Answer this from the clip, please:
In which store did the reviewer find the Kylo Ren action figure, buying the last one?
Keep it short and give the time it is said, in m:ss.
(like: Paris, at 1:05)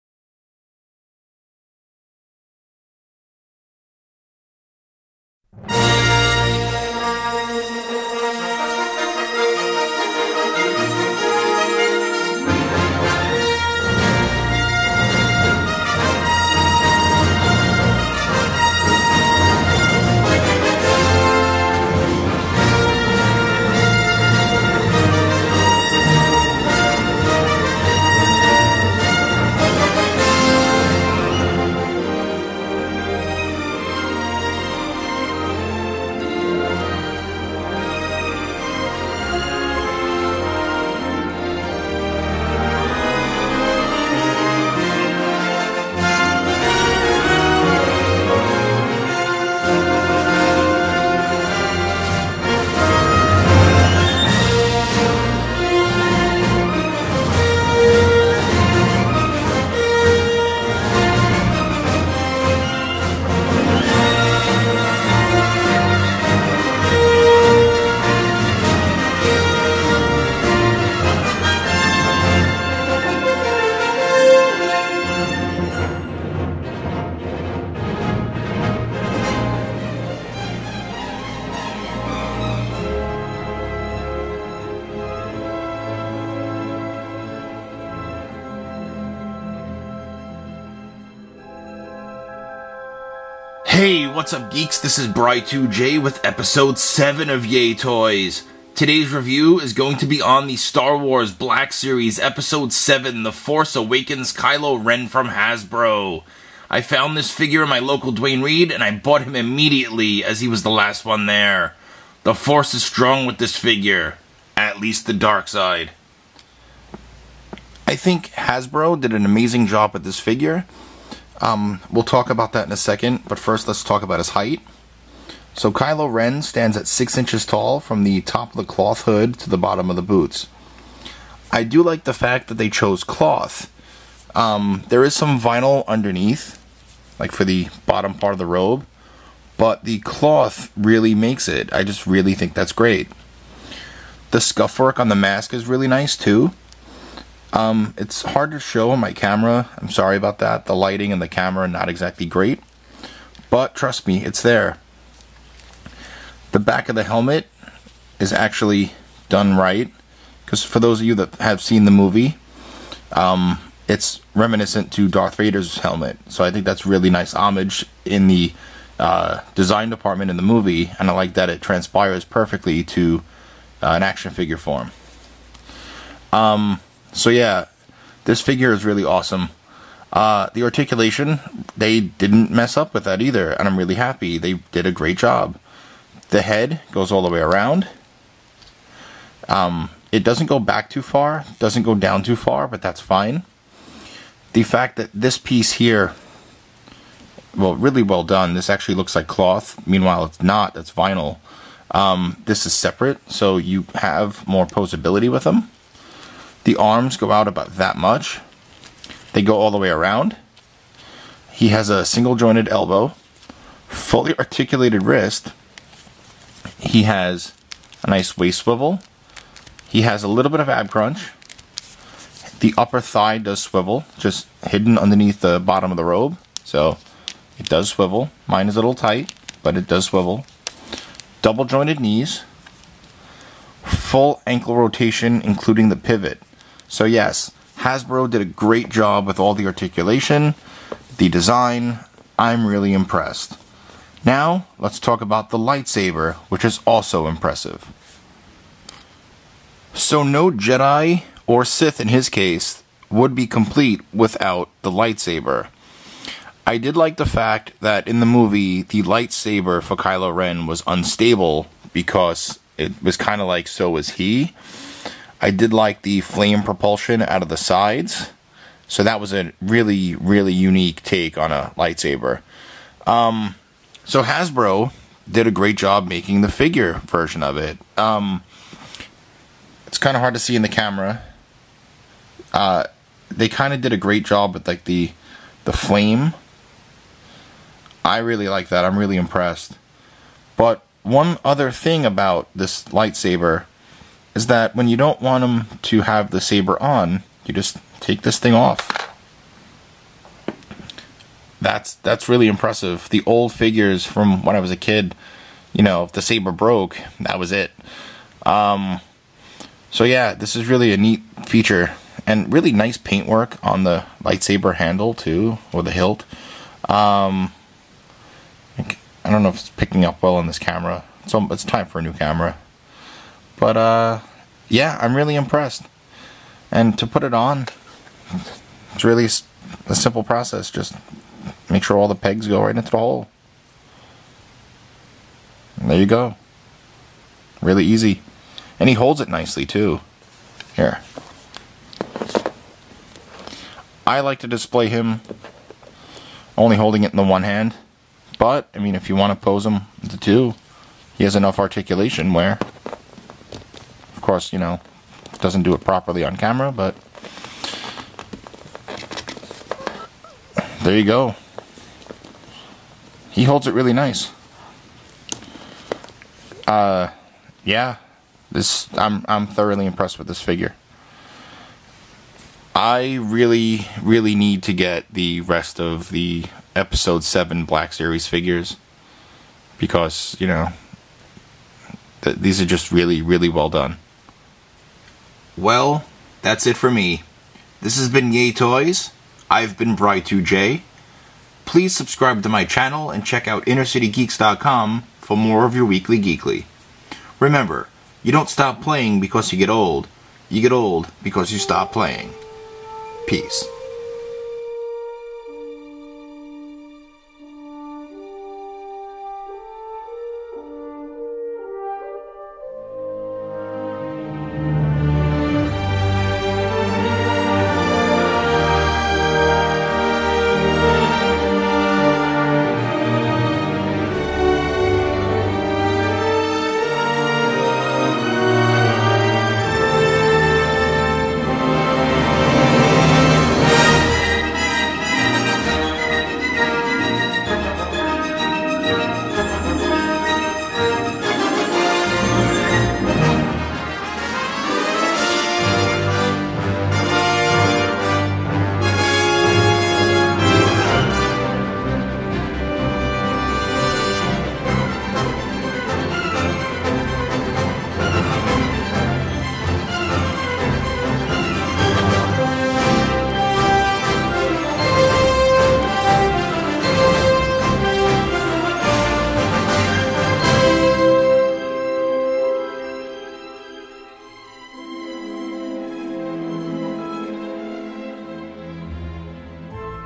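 Duane Reade, at 1:48.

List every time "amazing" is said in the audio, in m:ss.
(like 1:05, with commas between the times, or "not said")
1:59.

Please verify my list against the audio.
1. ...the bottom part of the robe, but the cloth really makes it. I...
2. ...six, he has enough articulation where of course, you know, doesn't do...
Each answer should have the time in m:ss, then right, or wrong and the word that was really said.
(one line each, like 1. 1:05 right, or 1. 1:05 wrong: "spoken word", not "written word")
1. 2:17 right
2. 5:50 wrong: "two", not "six".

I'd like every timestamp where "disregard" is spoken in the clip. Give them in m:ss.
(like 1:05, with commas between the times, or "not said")
not said.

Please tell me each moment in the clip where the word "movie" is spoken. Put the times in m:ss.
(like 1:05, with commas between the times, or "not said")
2:41, 2:50, 4:18.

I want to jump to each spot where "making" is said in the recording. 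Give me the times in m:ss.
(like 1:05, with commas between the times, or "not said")
4:36.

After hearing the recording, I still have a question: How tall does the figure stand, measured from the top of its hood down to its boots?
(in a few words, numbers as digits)
6 inches.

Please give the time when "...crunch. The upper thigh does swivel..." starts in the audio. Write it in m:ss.
3:40.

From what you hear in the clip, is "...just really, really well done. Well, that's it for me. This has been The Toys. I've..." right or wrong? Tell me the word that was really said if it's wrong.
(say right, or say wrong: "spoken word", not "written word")
wrong: "Yay", not "The".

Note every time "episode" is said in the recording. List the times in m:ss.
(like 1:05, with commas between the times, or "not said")
1:36, 1:42, 6:16.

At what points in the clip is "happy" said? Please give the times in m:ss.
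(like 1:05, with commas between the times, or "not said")
3:03.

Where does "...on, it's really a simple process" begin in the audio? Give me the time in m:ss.
5:27.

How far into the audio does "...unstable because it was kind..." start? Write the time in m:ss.
4:20.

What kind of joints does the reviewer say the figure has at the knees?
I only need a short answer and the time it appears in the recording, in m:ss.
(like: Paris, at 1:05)
Double jointed, at 3:51.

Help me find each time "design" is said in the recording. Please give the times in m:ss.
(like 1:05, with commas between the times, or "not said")
2:49, 4:01.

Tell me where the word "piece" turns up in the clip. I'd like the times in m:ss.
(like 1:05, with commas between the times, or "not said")
3:15.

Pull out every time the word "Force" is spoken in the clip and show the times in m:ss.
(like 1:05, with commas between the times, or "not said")
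1:43, 1:52.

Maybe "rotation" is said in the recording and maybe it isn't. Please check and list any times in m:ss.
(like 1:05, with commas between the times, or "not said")
3:54.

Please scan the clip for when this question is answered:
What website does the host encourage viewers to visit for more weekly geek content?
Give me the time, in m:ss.
6:33.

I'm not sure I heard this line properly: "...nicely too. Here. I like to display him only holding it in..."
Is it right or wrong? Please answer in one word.
right.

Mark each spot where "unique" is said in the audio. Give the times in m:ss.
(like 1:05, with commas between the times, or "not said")
4:30.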